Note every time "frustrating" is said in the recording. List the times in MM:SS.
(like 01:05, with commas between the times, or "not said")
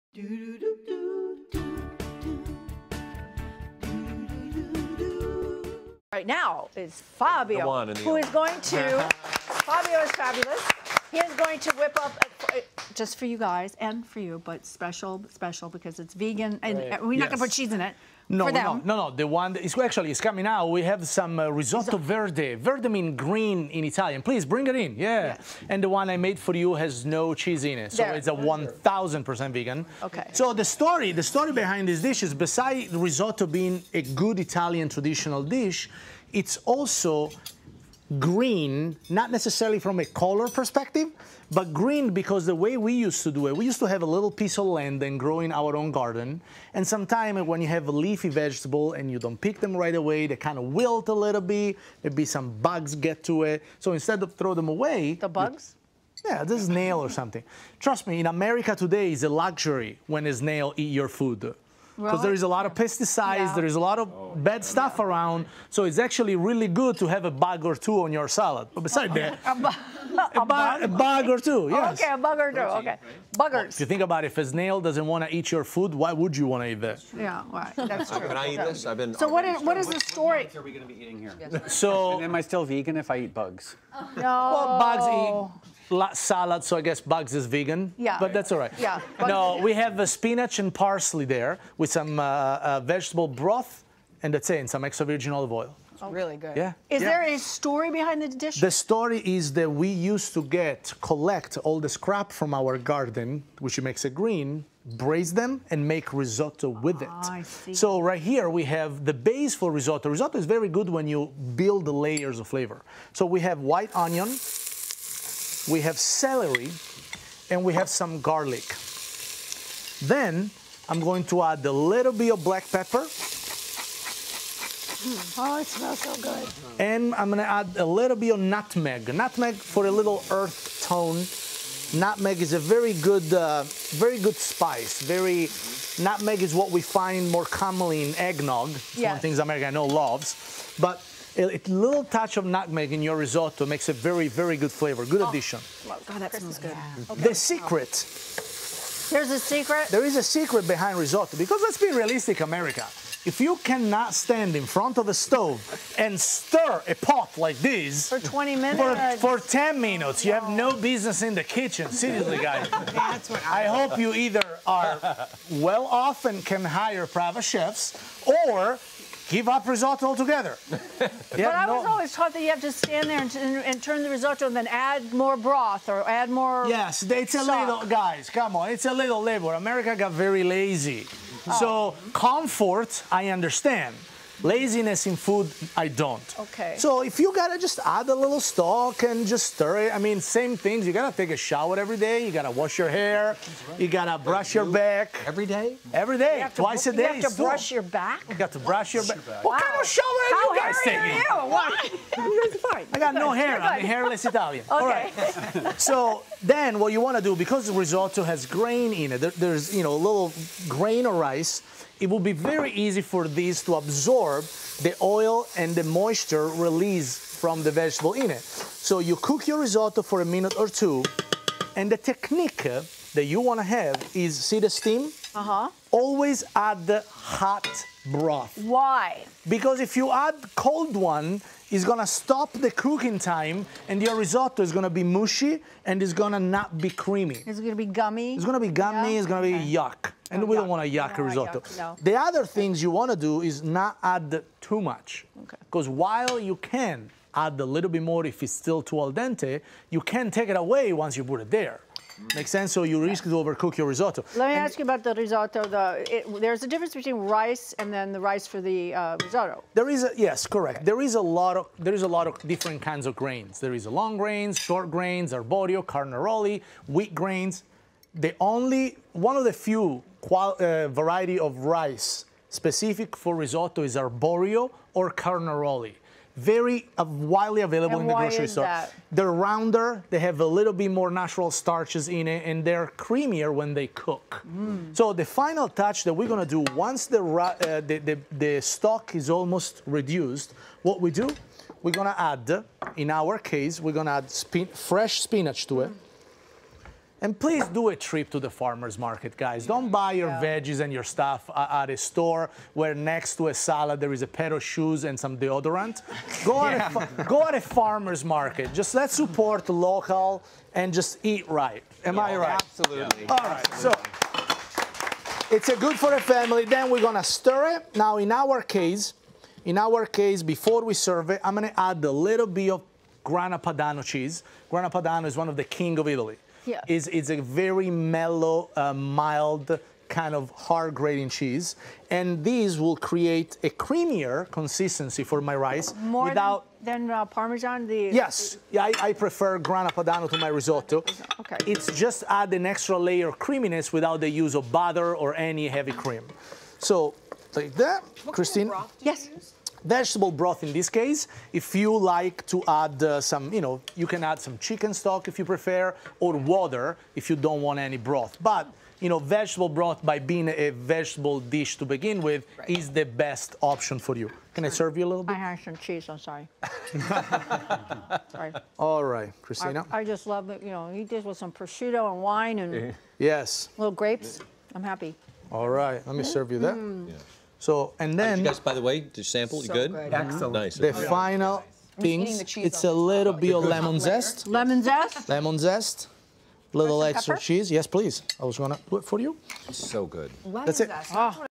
not said.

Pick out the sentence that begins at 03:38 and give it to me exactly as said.
So you cook your risotto for a minute or two, and the technique that you want to have is see the steam?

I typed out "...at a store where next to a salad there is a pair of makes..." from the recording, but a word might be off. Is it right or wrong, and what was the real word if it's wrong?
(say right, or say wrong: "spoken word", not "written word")
wrong: "shoes", not "makes".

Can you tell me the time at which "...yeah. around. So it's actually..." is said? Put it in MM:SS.
01:04.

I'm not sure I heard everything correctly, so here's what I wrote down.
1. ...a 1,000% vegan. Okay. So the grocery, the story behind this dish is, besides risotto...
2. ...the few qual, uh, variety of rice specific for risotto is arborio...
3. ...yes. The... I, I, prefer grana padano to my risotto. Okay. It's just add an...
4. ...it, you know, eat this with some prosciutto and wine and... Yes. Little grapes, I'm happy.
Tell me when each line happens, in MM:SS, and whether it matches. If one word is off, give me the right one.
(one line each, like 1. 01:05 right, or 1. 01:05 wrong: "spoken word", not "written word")
1. 00:28 wrong: "story", not "grocery"
2. 04:29 right
3. 05:38 right
4. 06:10 right.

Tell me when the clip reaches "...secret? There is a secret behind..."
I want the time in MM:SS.
02:29.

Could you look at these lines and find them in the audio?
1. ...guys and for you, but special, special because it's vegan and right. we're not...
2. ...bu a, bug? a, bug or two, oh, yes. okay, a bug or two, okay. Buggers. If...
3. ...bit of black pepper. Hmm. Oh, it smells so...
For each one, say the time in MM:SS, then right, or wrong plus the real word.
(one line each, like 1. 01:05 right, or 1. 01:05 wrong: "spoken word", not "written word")
1. 00:13 right
2. 01:09 right
3. 02:02 right.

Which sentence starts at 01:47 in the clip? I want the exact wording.
Ah, so right here we have the base for risotto.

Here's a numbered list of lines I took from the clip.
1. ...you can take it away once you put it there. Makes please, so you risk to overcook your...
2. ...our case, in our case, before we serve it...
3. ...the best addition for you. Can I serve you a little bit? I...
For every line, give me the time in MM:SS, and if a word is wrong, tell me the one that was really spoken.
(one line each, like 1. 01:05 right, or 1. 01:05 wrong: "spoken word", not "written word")
1. 04:09 wrong: "sense", not "please"
2. 05:18 right
3. 06:02 wrong: "option", not "addition".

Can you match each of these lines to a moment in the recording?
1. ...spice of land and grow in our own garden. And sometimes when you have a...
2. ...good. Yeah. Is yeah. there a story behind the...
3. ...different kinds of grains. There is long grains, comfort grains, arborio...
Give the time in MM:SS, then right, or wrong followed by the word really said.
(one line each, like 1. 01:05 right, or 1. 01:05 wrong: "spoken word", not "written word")
1. 00:44 wrong: "piece", not "spice"
2. 01:36 right
3. 04:22 wrong: "short", not "comfort".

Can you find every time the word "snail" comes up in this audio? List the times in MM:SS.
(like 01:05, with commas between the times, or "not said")
01:00, 01:14.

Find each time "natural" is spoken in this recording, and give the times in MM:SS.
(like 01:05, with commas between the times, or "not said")
04:41.